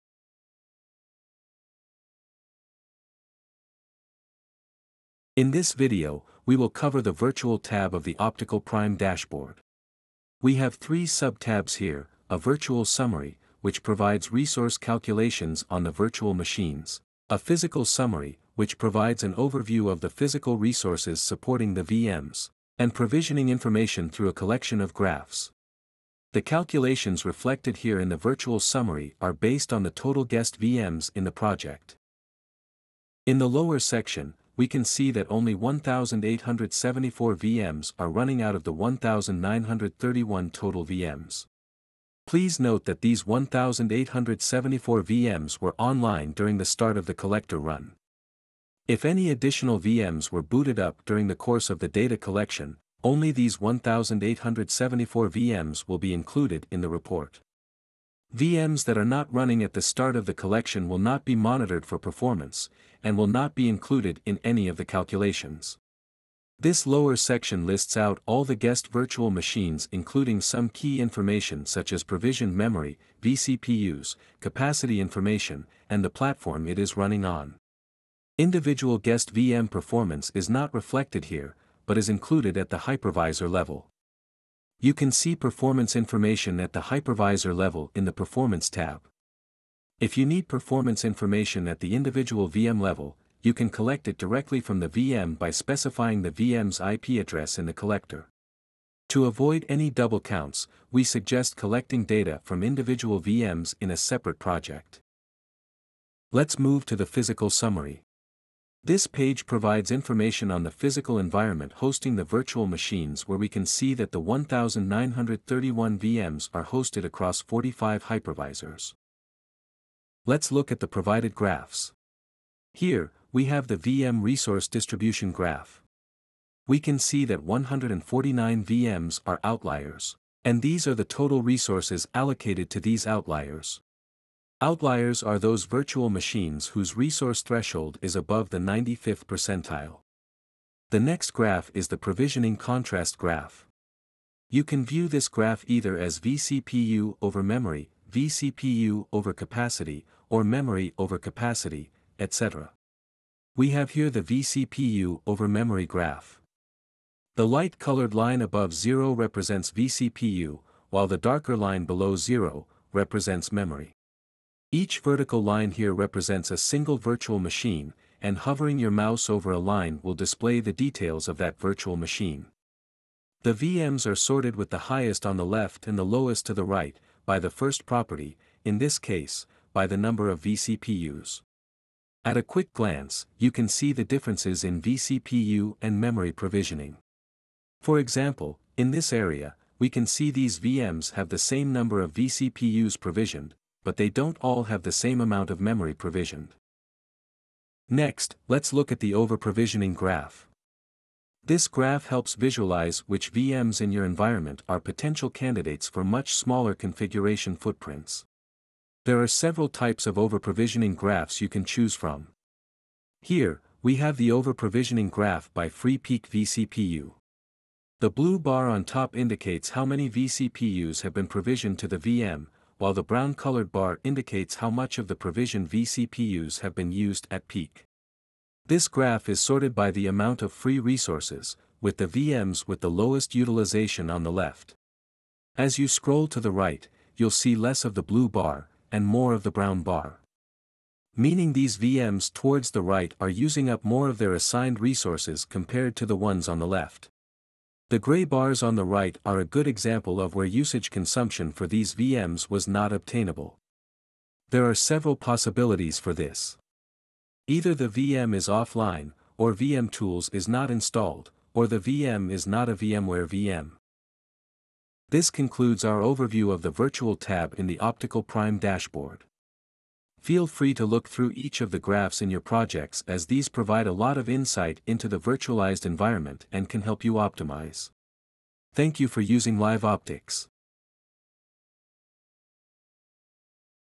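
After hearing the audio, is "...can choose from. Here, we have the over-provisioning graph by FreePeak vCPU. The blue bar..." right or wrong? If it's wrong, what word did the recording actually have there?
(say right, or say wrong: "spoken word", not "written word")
right.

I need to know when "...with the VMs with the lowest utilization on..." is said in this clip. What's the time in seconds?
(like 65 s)
231 s.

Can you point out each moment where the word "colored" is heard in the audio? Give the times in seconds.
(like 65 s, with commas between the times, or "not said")
157 s, 223 s.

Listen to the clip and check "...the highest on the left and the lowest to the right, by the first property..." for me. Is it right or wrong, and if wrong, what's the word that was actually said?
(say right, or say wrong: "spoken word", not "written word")
right.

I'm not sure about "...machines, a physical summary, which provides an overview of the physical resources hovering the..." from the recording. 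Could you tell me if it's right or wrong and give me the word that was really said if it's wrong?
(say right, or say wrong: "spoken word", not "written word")
wrong: "supporting", not "hovering".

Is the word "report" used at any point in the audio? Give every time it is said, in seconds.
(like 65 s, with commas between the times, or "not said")
56 s.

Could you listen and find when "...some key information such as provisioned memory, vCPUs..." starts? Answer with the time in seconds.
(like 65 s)
70 s.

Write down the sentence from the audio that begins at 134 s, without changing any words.
Outliers are those virtual machines whose resource threshold is above the 95th percentile.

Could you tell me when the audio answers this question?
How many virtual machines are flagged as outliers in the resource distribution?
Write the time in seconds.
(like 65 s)
127 s.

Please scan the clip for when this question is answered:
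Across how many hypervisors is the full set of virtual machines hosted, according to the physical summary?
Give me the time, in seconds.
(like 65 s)
117 s.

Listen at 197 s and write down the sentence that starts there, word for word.
Next, let's look at the over-provisioning graph.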